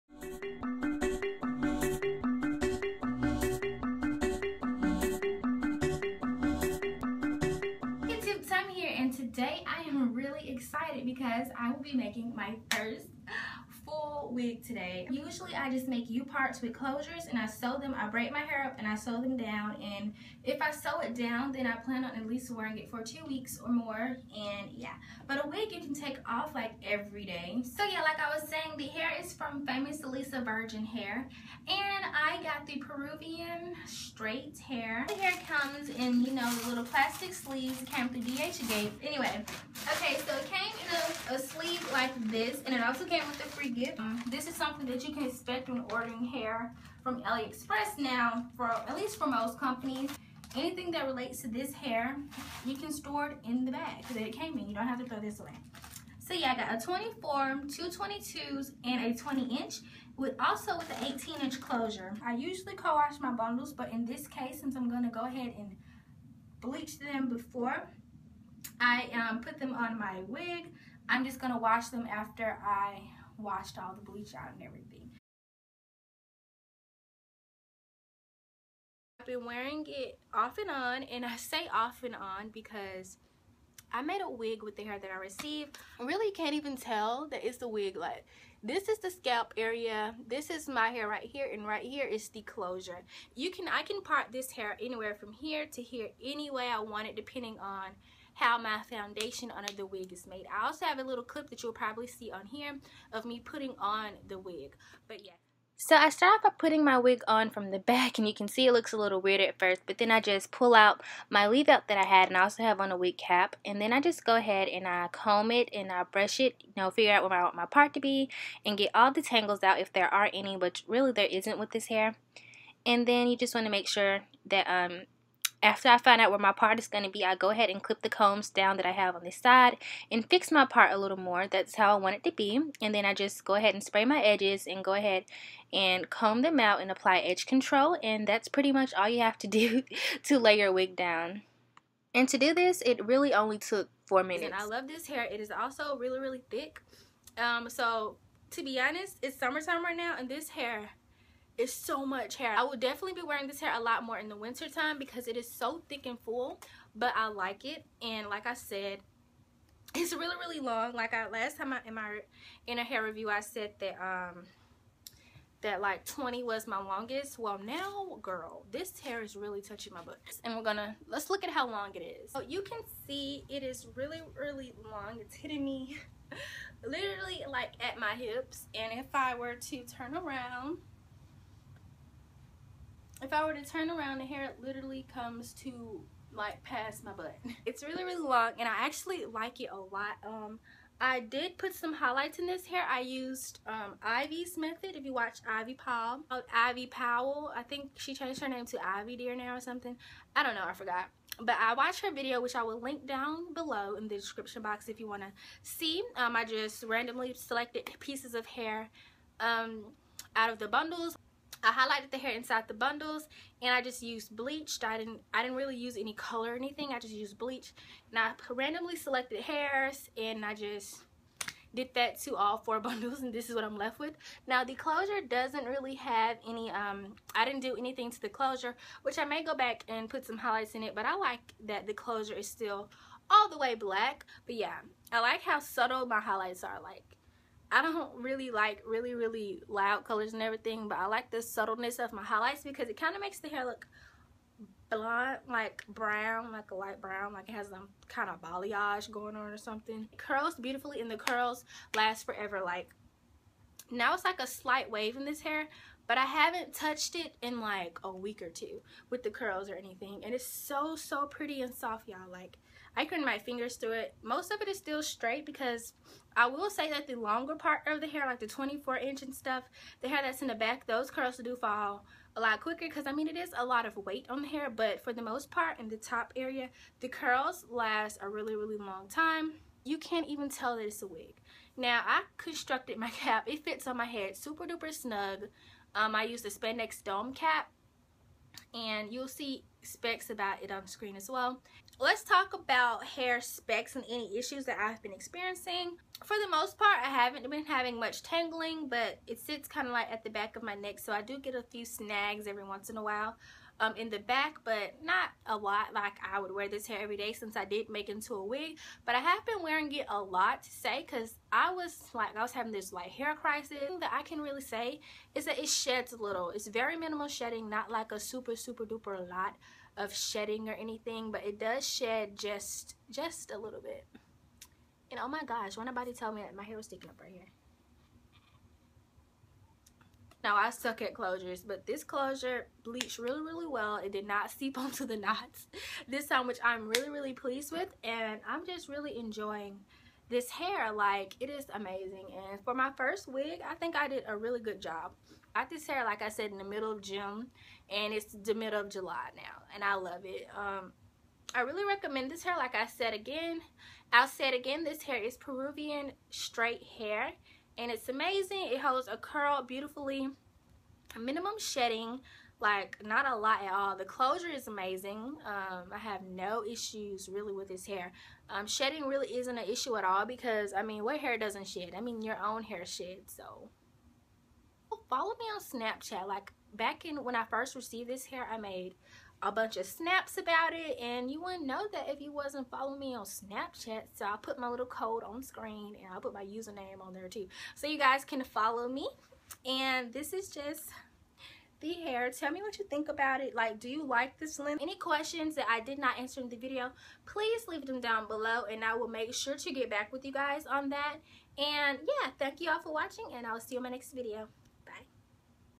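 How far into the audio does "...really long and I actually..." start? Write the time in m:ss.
3:08.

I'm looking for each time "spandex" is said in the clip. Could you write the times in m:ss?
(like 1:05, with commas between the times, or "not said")
4:46.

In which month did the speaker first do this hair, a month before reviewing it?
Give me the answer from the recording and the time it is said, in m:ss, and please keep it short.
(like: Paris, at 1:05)
June, at 5:47.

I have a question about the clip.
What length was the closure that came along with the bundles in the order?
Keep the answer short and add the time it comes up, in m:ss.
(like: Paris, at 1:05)
18 inch, at 1:01.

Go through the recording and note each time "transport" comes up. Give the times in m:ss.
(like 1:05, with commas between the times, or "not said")
not said.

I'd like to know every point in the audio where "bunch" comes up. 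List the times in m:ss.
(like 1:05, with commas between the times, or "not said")
6:19.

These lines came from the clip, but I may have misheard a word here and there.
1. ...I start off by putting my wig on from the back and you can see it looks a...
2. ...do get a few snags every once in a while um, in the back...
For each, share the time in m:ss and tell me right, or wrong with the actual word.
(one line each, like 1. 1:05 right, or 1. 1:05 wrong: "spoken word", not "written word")
1. 1:45 right
2. 5:01 right.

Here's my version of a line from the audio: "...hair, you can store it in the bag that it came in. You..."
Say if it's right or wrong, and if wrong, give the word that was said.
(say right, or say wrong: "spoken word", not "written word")
right.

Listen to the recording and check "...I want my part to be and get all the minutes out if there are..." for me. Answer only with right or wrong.
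wrong.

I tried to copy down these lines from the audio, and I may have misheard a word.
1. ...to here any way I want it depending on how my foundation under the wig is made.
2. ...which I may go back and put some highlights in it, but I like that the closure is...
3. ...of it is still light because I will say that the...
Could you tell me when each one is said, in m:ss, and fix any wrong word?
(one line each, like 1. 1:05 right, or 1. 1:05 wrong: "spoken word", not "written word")
1. 1:35 right
2. 3:49 right
3. 4:24 wrong: "straight", not "light".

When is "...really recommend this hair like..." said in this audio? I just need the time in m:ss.
5:51.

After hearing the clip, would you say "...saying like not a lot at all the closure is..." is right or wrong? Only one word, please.
wrong.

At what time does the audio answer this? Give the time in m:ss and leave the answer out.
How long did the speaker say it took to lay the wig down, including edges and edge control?
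2:24.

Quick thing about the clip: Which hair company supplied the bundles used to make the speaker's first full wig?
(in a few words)
Famous Lisa Virgin Hair.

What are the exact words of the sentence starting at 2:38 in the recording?
And like I said, it's really, really long.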